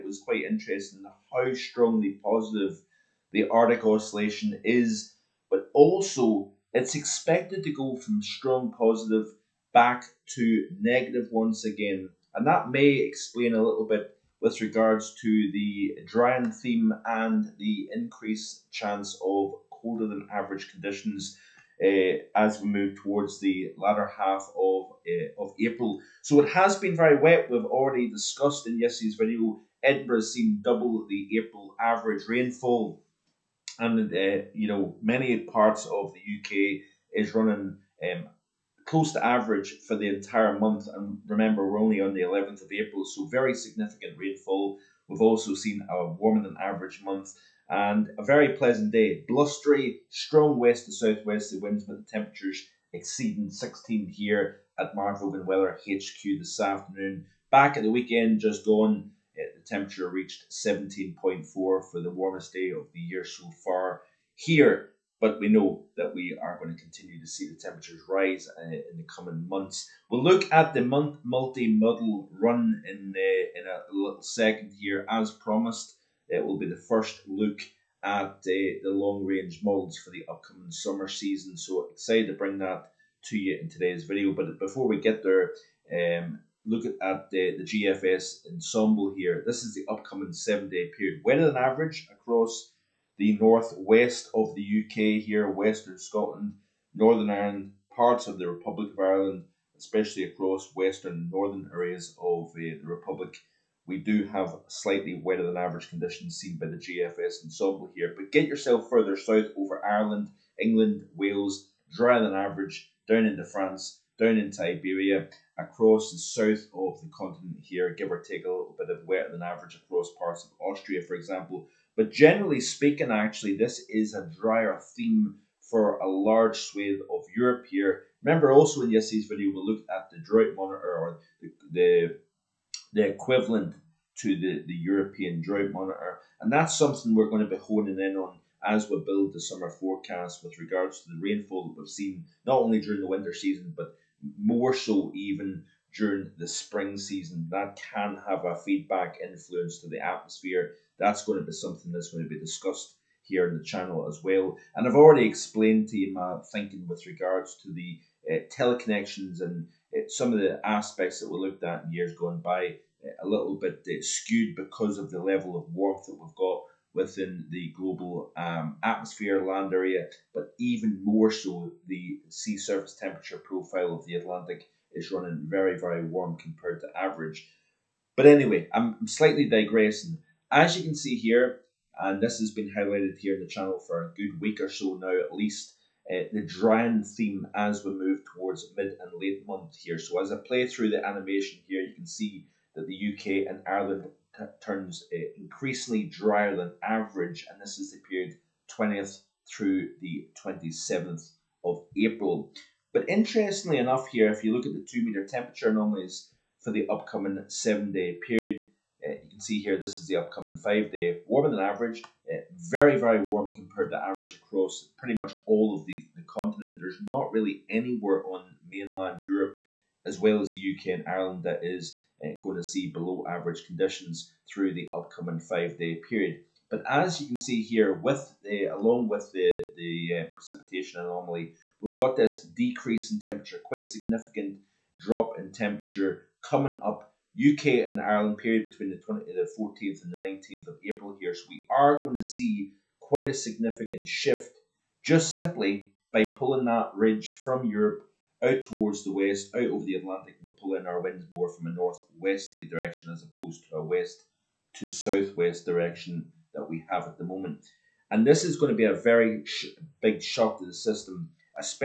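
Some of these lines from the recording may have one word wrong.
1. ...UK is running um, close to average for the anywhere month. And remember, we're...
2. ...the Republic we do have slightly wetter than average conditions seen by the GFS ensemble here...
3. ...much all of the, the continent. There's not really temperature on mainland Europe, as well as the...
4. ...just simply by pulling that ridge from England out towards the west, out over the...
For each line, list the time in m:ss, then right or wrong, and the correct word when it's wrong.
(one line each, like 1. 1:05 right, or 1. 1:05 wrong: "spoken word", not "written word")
1. 0:36 wrong: "entire", not "anywhere"
2. 1:42 right
3. 3:35 wrong: "anywhere", not "temperature"
4. 4:05 wrong: "Europe", not "England".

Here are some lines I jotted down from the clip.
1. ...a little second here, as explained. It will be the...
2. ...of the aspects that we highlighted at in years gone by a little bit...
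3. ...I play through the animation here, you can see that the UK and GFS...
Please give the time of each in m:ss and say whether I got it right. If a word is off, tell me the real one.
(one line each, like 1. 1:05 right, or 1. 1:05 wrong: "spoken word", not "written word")
1. 1:13 wrong: "promised", not "explained"
2. 2:40 wrong: "looked", not "highlighted"
3. 3:10 wrong: "Ireland", not "GFS".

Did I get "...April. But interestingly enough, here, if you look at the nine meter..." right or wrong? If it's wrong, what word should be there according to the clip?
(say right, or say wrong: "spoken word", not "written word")
wrong: "two", not "nine".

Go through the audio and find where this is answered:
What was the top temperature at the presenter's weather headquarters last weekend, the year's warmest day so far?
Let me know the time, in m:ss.
1:00.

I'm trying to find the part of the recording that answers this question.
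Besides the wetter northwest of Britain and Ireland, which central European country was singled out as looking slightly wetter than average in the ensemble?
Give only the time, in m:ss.
2:00.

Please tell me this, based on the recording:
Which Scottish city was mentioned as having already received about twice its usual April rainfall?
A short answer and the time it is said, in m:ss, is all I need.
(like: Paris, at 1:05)
Edinburgh, at 0:29.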